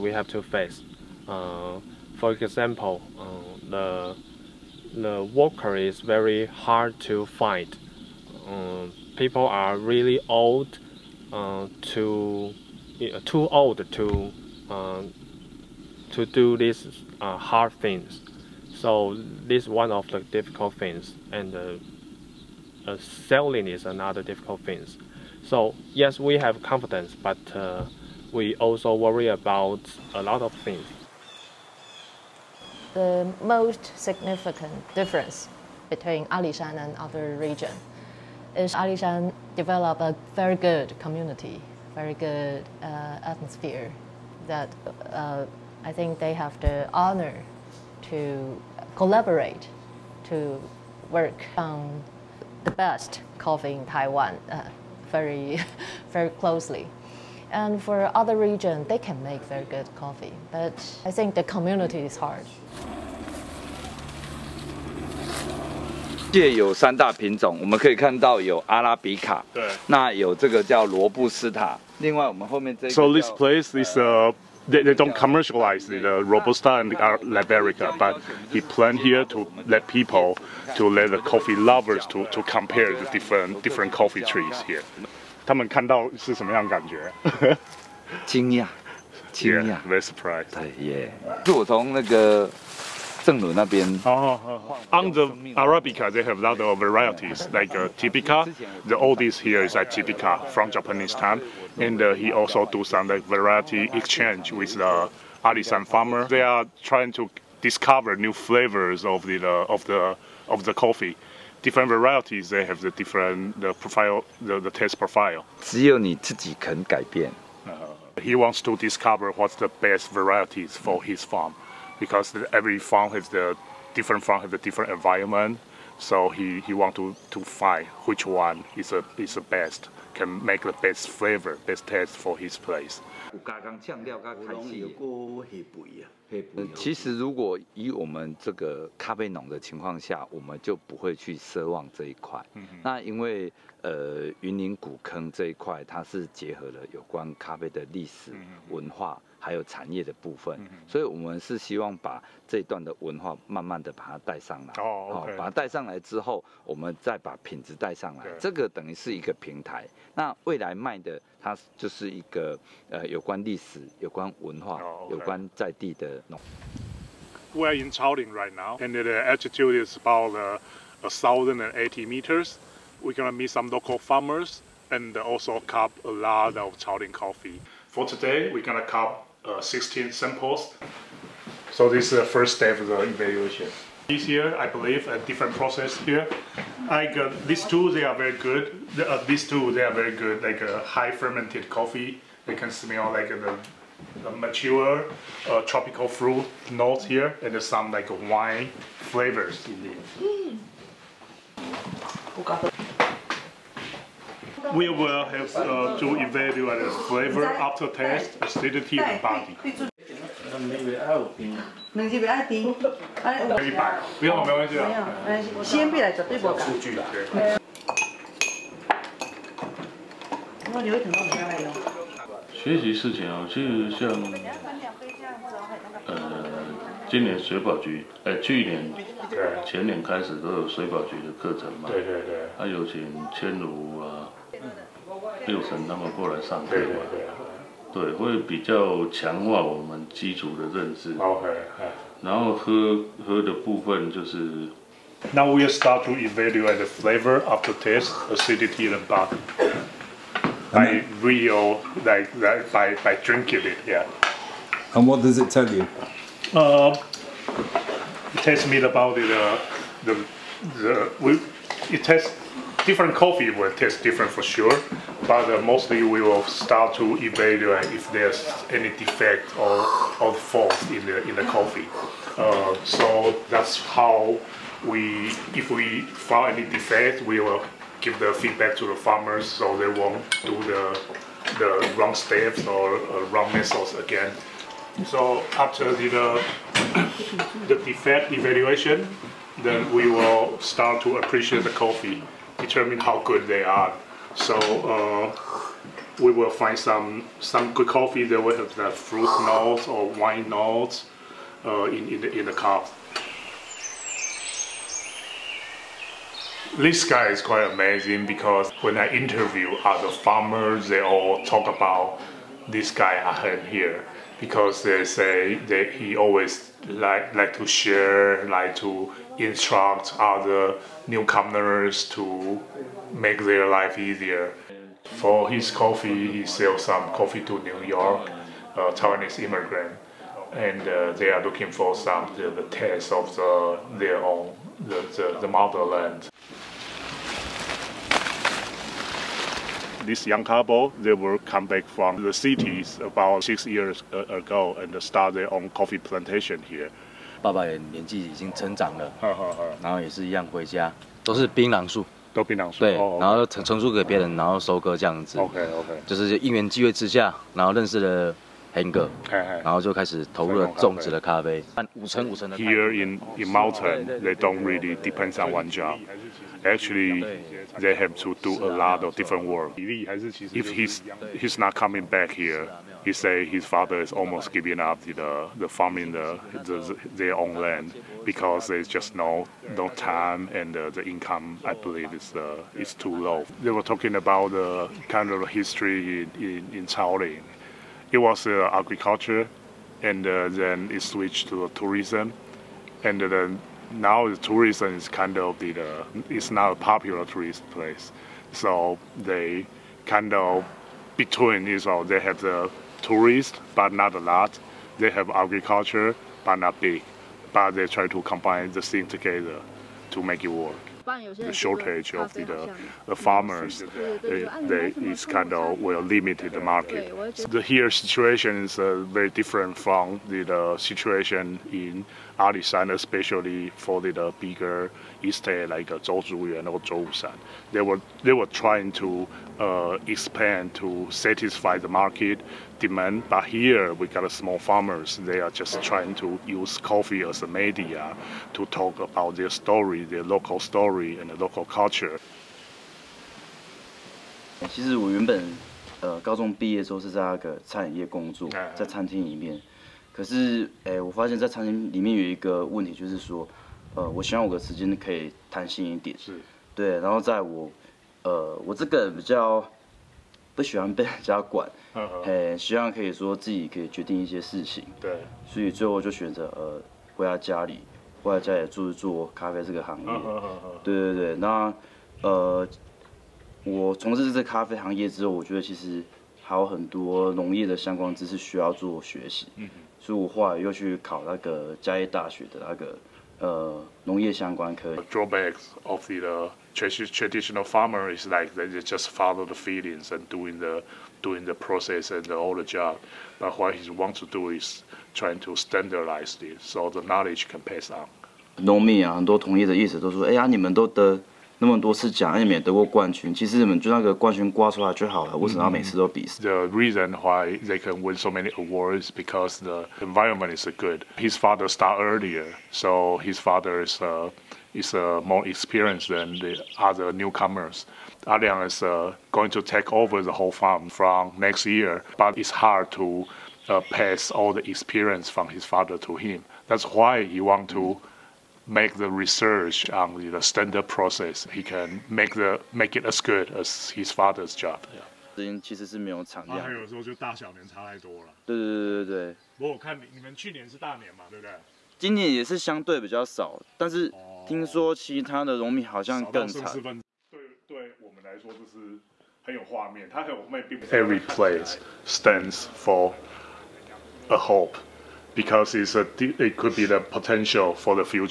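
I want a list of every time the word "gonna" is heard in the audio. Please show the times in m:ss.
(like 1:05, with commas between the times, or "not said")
2:53, 2:58.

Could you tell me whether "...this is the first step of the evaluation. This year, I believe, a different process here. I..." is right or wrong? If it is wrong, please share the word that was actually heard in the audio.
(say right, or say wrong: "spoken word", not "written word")
right.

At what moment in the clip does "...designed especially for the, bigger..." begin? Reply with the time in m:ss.
7:02.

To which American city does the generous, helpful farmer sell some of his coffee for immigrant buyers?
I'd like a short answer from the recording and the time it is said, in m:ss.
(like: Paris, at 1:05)
New York, at 5:27.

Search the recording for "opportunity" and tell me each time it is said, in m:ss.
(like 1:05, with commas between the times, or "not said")
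not said.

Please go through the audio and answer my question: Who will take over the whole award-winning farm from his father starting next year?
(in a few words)
Alian.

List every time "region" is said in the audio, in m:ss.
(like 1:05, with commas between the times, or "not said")
0:37, 0:58.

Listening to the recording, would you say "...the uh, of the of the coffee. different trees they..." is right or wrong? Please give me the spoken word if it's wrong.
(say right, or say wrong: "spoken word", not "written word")
wrong: "varieties", not "trees".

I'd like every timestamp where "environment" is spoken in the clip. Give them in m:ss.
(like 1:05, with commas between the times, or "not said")
2:04, 8:30.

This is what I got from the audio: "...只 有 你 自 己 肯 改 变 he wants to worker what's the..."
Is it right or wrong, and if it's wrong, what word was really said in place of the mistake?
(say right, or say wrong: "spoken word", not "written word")
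wrong: "discover", not "worker".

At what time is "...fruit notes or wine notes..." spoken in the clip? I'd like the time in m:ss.
4:58.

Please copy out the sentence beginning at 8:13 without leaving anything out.
But what he want to do is trying to standardize it, so the knowledge can pass on.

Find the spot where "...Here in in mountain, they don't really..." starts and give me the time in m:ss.
6:02.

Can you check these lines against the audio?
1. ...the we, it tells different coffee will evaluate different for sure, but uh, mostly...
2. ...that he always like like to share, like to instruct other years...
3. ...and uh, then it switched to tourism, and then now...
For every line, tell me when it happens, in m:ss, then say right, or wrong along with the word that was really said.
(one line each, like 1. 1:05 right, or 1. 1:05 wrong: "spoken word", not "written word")
1. 4:20 wrong: "taste", not "evaluate"
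2. 5:15 wrong: "newcomers", not "years"
3. 6:30 right.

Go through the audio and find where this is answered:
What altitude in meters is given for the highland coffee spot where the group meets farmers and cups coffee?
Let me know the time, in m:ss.
2:50.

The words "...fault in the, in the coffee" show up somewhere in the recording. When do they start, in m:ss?
4:30.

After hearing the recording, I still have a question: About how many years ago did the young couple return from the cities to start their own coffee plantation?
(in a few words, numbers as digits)
6 years.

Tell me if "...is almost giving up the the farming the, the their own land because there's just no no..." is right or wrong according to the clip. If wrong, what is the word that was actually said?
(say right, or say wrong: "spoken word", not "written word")
right.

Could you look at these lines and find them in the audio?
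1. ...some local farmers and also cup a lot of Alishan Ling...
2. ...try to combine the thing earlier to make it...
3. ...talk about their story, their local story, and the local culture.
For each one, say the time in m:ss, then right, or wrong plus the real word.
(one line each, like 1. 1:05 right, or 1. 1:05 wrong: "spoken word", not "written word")
1. 2:53 wrong: "Chao", not "Alishan"
2. 6:47 wrong: "together", not "earlier"
3. 7:18 right.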